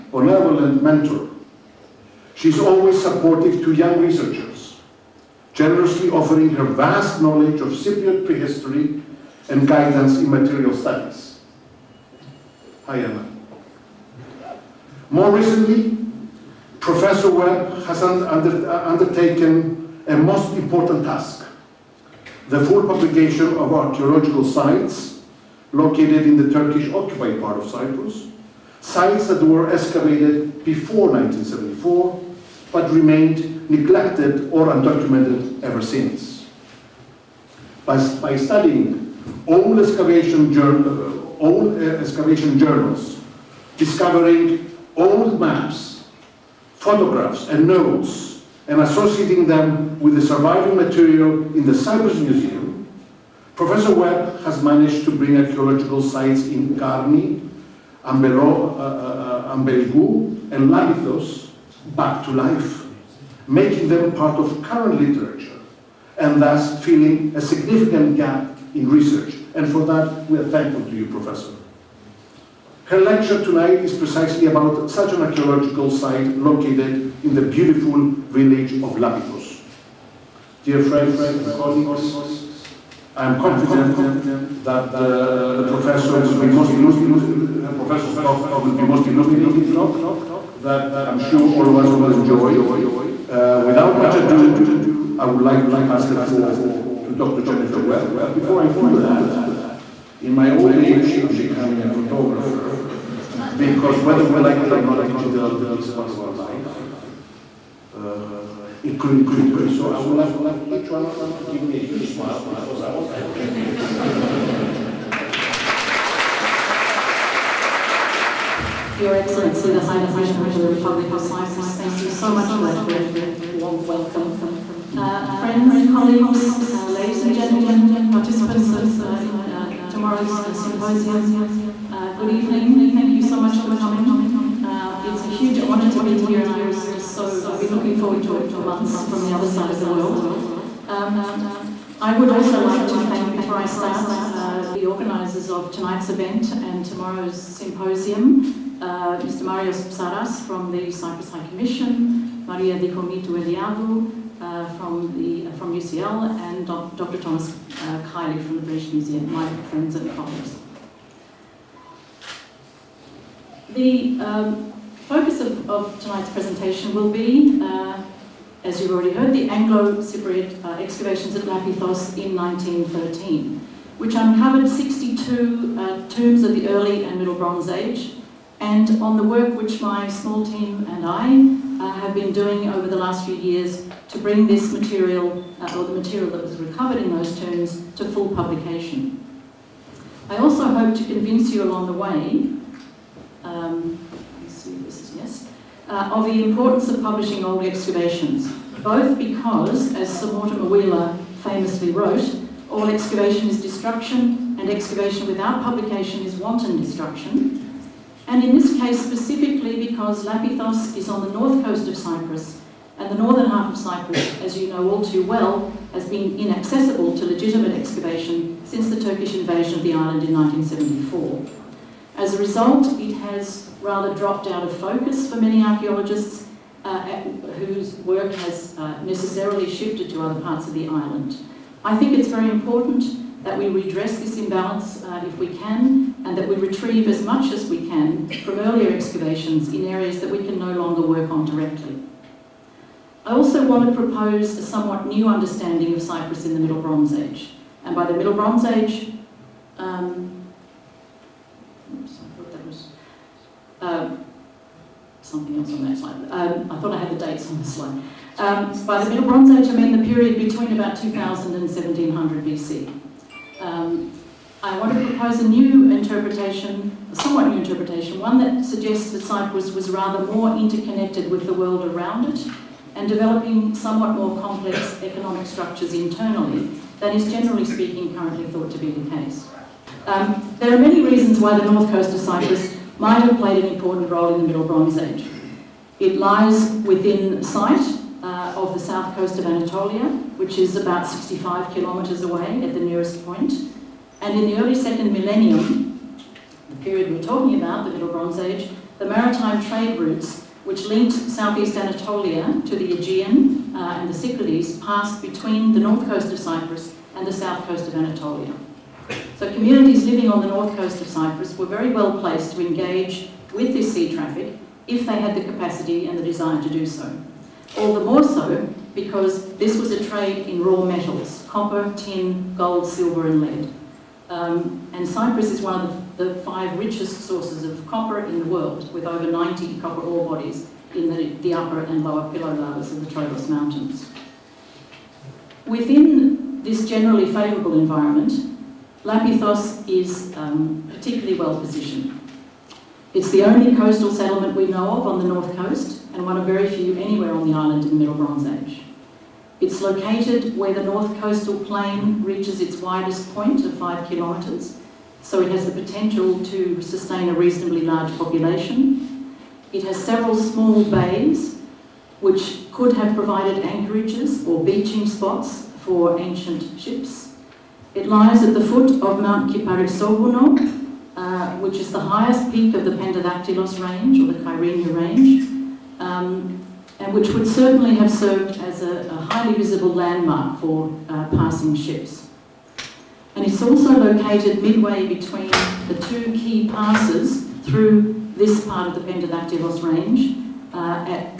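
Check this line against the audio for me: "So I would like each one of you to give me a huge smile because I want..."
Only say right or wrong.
right.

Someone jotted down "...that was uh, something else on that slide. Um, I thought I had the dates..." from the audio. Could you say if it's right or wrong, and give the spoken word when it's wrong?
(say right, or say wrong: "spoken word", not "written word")
right.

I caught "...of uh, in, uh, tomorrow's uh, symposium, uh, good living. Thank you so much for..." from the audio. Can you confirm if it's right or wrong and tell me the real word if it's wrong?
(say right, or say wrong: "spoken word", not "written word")
wrong: "evening", not "living".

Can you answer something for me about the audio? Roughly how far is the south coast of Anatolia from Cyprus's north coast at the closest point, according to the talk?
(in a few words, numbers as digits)
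65 kilometers.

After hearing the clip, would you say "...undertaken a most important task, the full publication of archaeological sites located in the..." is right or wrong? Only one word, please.
right.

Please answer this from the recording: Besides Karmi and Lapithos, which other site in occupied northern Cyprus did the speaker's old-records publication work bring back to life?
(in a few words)
Ambelo.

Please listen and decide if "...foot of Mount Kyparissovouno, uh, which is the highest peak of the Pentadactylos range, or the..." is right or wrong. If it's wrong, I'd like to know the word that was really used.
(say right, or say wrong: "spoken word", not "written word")
right.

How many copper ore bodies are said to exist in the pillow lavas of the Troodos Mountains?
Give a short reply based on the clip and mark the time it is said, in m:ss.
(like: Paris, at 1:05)
over 90, at 5:29.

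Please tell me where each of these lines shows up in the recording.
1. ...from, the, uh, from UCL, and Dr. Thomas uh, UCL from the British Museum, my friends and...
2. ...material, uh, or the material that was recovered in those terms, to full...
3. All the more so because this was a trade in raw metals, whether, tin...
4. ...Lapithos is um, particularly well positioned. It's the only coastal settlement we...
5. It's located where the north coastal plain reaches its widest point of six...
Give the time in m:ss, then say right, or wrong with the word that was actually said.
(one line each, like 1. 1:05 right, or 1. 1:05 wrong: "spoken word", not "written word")
1. 2:34 wrong: "Kiely", not "UCL"
2. 3:04 right
3. 5:17 wrong: "copper", not "whether"
4. 5:39 right
5. 5:49 wrong: "five", not "six".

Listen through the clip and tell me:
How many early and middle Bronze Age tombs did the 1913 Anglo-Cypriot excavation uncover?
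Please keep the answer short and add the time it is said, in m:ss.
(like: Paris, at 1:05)
62, at 2:54.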